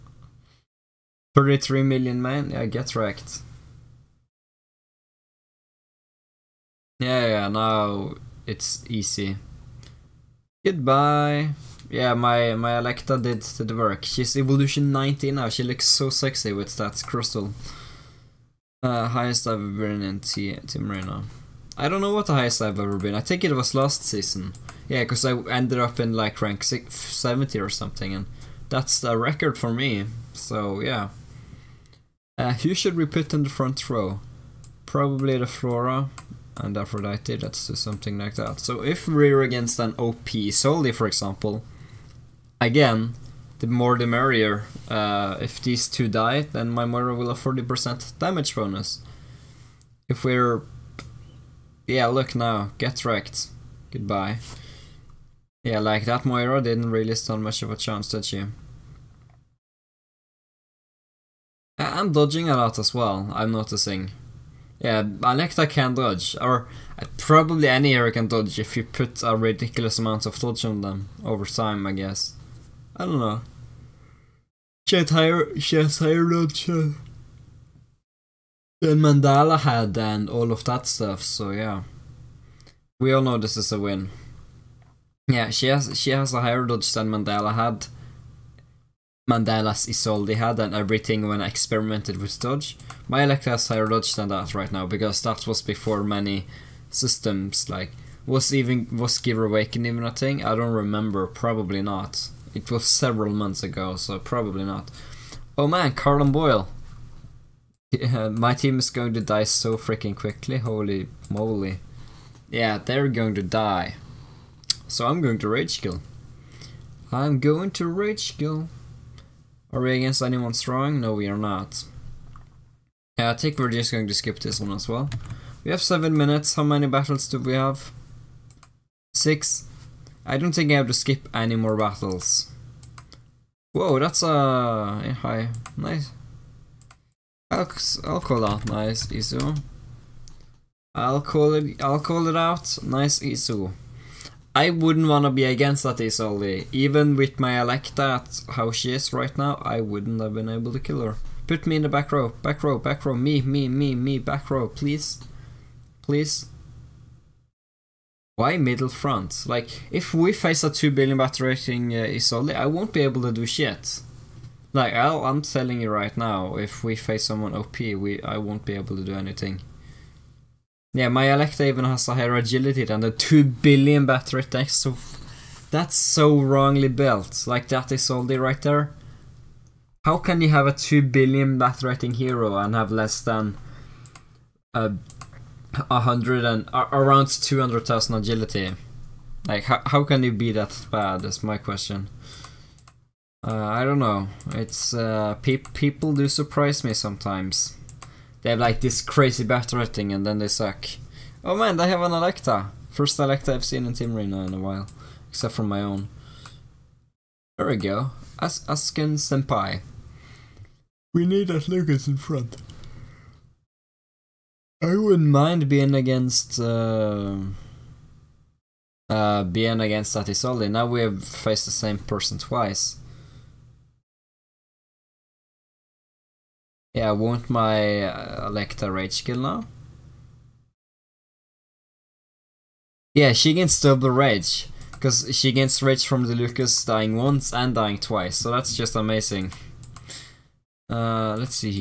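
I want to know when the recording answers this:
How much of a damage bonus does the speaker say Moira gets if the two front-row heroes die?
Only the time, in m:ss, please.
0:47.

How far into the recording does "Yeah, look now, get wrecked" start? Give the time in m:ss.
0:51.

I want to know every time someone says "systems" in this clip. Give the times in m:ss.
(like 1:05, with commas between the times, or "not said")
1:36.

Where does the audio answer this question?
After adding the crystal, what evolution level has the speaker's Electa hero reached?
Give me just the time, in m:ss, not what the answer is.
0:14.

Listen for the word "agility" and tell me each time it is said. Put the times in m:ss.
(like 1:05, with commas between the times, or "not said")
2:52, 3:08.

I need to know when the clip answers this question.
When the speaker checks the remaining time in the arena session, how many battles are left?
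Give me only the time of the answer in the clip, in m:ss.
2:09.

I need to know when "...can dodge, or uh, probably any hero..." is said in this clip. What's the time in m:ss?
1:05.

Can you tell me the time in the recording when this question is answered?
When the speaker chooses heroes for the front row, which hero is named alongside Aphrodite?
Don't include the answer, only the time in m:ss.
0:35.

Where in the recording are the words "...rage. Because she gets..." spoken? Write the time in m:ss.
3:54.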